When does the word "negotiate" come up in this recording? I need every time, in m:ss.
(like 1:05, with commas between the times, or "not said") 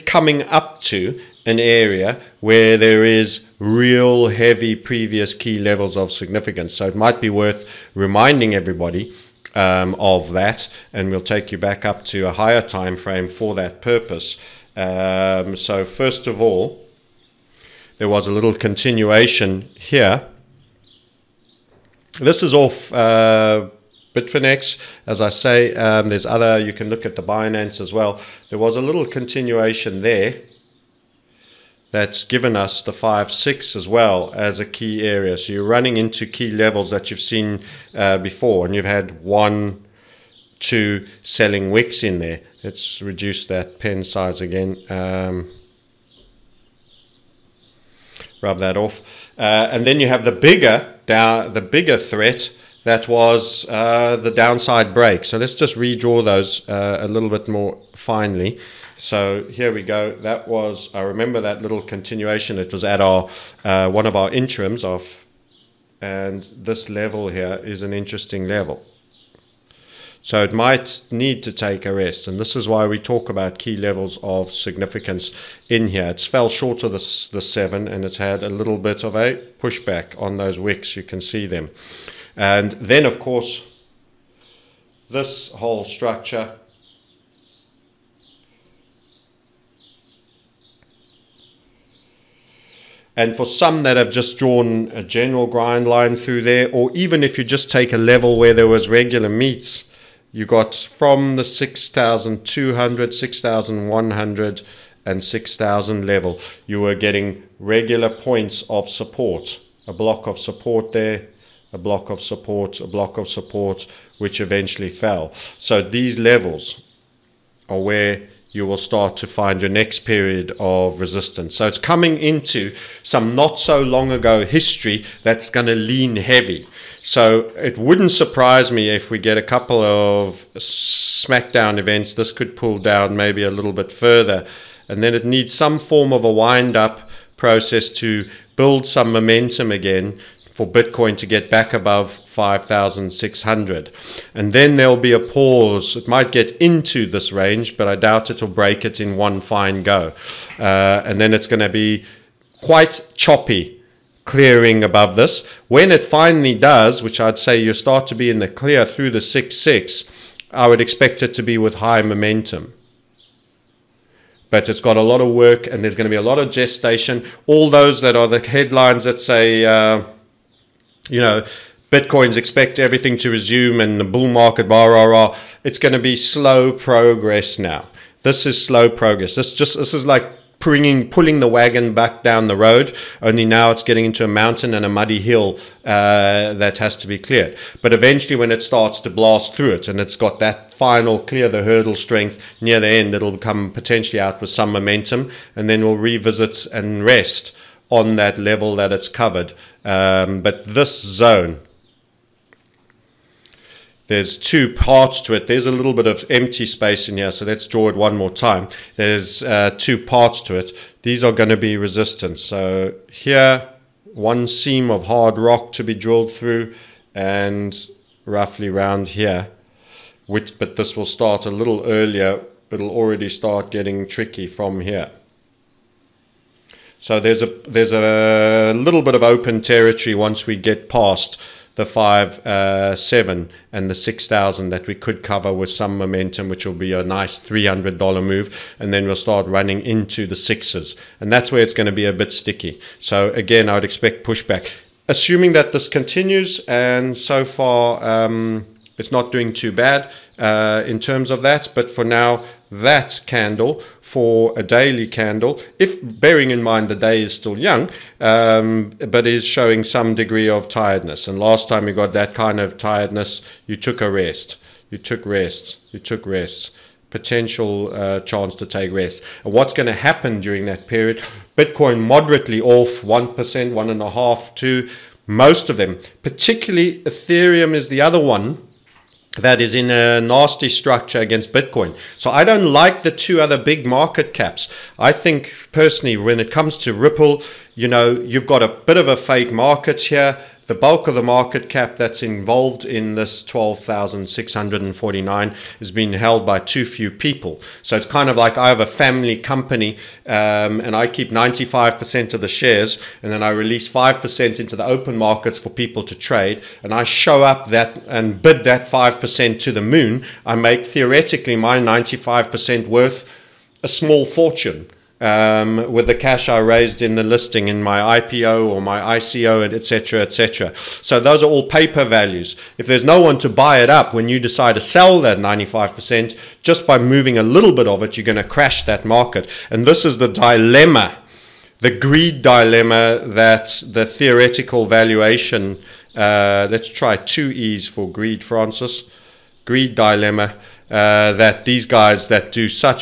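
not said.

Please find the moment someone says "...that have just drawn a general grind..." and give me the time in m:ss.
1:33.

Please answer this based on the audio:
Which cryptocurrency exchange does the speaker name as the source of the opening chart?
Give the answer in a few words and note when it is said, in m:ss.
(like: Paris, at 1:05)
Bitfinex, at 0:24.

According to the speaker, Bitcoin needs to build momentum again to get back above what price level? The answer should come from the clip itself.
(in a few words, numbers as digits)
5,600.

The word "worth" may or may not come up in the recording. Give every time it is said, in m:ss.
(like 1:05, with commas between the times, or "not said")
0:07, 5:12.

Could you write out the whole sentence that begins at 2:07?
So it wouldn't surprise me if we get a couple of SmackDown events.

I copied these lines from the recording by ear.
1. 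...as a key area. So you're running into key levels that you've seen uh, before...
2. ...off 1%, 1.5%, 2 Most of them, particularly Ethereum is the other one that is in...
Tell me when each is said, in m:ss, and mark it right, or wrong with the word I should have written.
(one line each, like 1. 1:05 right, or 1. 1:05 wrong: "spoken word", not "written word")
1. 0:34 right
2. 4:32 right.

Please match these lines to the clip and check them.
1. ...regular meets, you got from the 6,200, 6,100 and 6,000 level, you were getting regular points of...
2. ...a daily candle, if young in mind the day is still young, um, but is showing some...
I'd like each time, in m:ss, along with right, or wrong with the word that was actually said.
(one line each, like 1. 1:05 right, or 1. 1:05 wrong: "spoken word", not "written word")
1. 1:38 right
2. 4:14 wrong: "bearing", not "young".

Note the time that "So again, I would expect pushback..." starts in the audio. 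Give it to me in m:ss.
4:02.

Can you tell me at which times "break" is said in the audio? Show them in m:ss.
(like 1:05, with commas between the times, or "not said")
0:54, 2:28.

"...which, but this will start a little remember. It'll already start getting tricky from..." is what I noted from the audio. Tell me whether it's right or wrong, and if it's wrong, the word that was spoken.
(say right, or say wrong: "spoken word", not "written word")
wrong: "earlier", not "remember".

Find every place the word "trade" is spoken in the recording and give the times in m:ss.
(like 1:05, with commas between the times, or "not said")
5:06.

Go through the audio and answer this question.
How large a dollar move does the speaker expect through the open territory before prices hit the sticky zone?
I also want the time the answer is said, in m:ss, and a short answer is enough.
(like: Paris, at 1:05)
$300, at 3:57.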